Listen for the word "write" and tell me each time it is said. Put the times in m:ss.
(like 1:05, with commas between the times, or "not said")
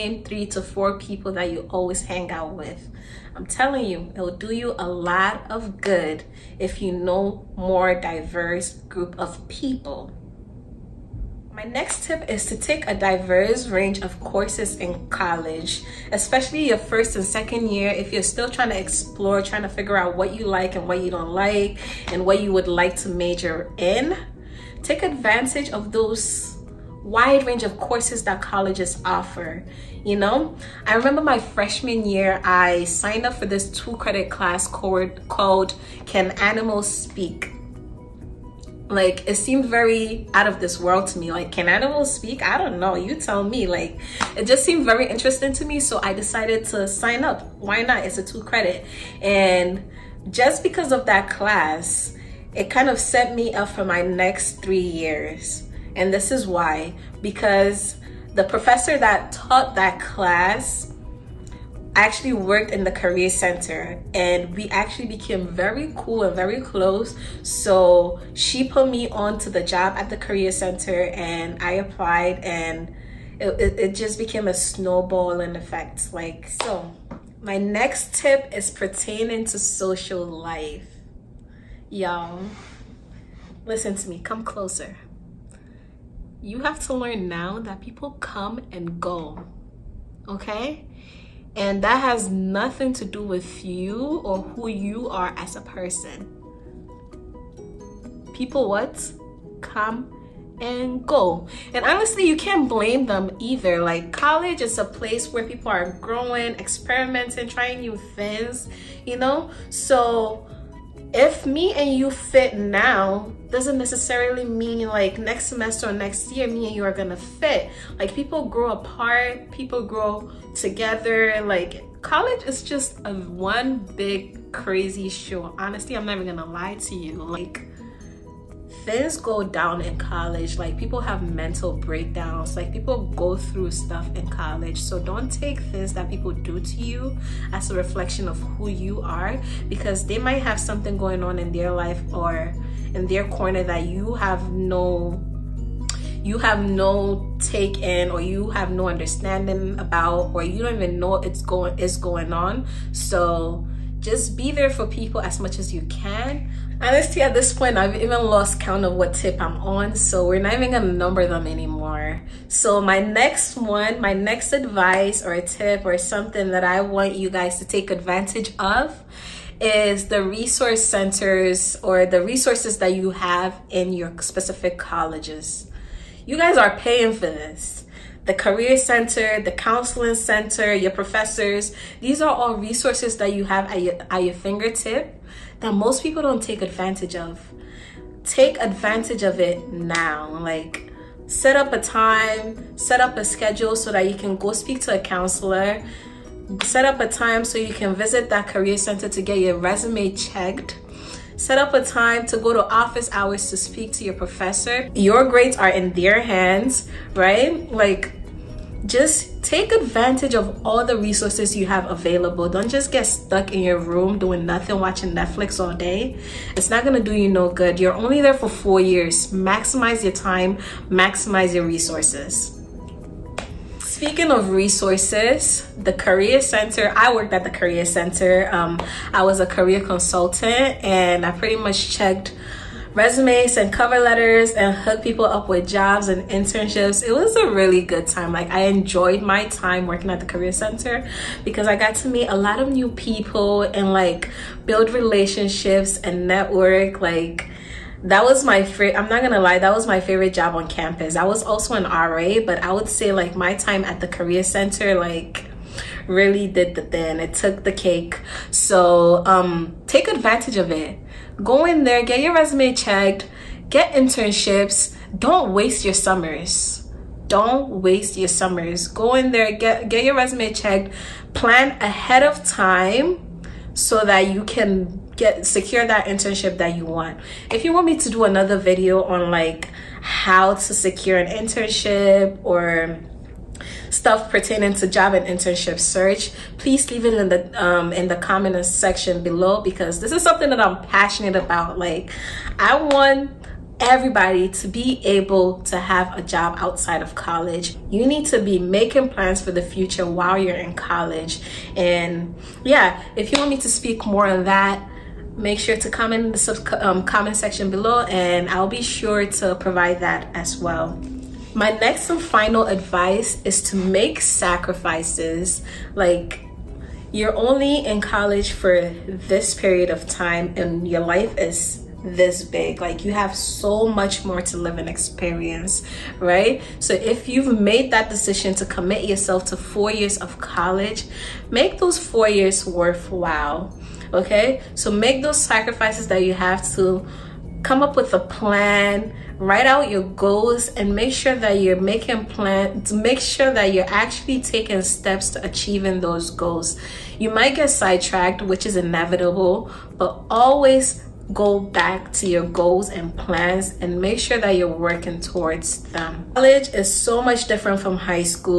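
5:39.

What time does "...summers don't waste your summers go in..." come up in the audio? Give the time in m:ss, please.
4:25.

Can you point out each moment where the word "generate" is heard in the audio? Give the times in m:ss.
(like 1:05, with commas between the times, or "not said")
not said.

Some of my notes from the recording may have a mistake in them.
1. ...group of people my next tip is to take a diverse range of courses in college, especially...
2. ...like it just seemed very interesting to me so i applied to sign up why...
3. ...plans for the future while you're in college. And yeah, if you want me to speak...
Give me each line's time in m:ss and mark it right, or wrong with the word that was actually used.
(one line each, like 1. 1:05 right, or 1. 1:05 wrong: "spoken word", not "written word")
1. 0:08 right
2. 0:43 wrong: "decided", not "applied"
3. 4:59 right.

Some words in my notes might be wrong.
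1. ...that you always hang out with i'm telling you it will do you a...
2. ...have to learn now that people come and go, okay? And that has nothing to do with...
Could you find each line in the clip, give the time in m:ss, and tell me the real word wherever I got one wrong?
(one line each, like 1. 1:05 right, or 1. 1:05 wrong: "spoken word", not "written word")
1. 0:01 right
2. 1:26 right.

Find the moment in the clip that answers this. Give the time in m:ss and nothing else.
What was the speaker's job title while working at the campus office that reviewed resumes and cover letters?
3:49.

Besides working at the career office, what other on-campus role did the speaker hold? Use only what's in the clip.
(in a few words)
RA.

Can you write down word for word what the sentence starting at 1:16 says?
Like, so my next tip is pertaining to social life.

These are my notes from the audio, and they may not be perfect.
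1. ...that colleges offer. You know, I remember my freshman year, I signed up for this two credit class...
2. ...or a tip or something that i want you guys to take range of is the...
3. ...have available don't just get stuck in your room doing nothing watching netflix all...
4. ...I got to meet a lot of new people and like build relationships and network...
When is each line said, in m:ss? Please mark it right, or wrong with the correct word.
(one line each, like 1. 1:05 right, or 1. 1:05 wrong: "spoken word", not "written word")
1. 0:28 right
2. 2:45 wrong: "advantage", not "range"
3. 3:31 right
4. 4:01 right.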